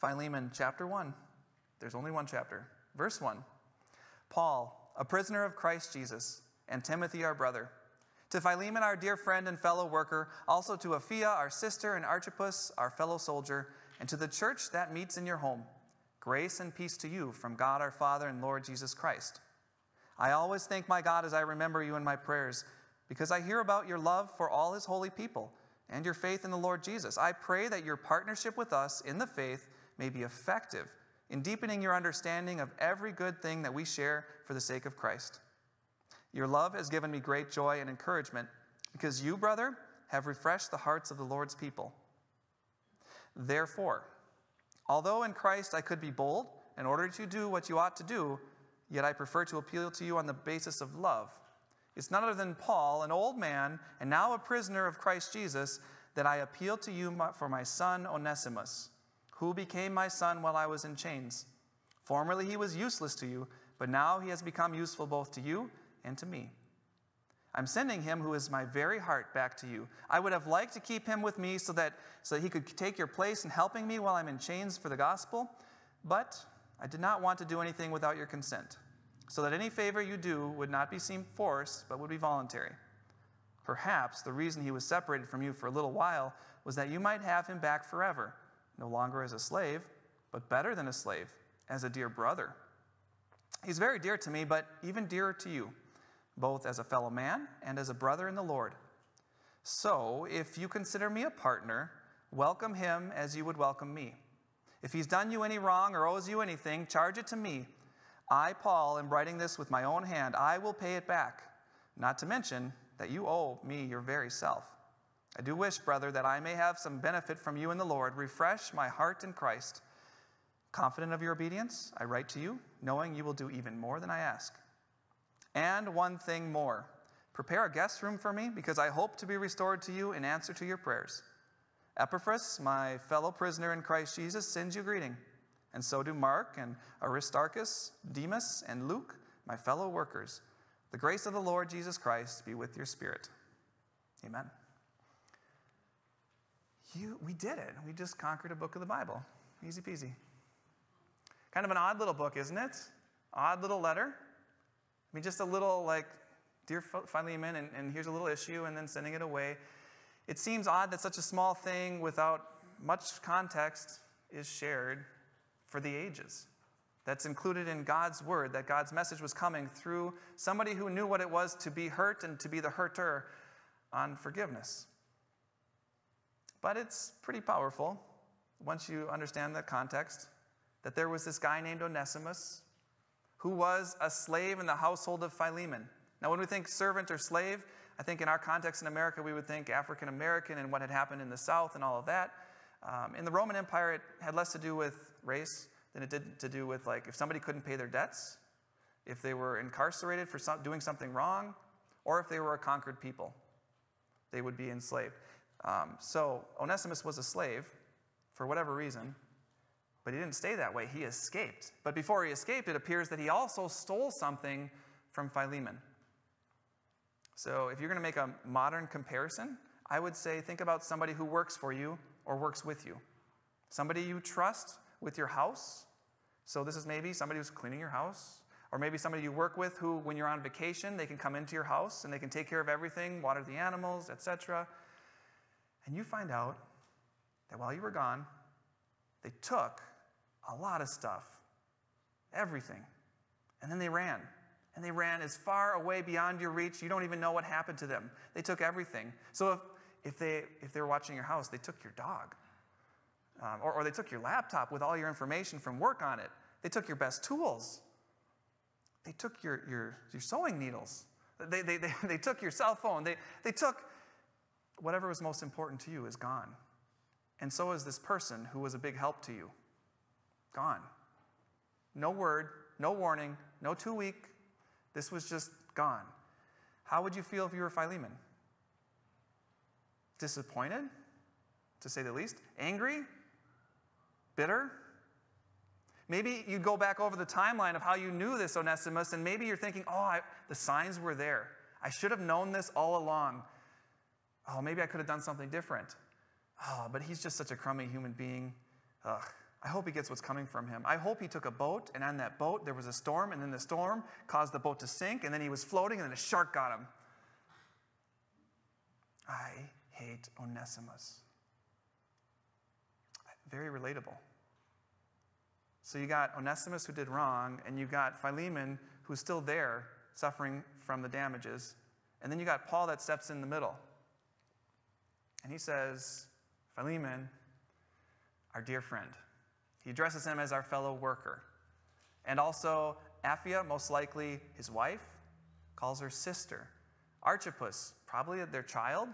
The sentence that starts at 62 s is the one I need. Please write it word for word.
Formerly he was useless to you, but now he has become useful both to you and to me.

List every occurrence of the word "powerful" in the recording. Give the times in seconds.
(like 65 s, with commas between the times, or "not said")
177 s.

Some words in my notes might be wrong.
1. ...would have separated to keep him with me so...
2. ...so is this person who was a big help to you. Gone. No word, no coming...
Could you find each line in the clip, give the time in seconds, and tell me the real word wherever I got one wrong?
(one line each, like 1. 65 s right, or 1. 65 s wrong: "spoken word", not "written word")
1. 70 s wrong: "liked", not "separated"
2. 267 s wrong: "warning", not "coming".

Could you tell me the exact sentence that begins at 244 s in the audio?
And they ran as far away beyond your reach, you don't even know what happened to them.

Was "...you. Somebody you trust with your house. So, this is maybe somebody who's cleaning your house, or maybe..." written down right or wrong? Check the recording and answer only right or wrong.
right.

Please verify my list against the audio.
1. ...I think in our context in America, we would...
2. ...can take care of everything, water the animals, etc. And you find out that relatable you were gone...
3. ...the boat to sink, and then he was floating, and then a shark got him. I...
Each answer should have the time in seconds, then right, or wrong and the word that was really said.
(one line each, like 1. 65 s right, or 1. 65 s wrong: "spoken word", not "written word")
1. 187 s right
2. 232 s wrong: "while", not "relatable"
3. 304 s right.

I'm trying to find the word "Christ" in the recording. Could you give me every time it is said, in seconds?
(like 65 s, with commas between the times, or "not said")
5 s, 18 s, 34 s, 45 s, 54 s, 119 s, 133 s, 141 s.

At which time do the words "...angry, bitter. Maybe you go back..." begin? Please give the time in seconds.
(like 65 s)
282 s.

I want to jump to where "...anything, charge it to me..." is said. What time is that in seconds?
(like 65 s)
106 s.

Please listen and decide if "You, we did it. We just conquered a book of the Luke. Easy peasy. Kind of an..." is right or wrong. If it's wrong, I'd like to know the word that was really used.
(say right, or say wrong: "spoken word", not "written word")
wrong: "Bible", not "Luke".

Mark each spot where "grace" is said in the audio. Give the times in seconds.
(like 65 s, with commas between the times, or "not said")
16 s, 140 s.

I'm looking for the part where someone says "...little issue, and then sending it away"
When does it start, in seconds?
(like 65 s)
158 s.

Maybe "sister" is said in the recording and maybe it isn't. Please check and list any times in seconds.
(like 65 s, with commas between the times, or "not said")
11 s, 336 s.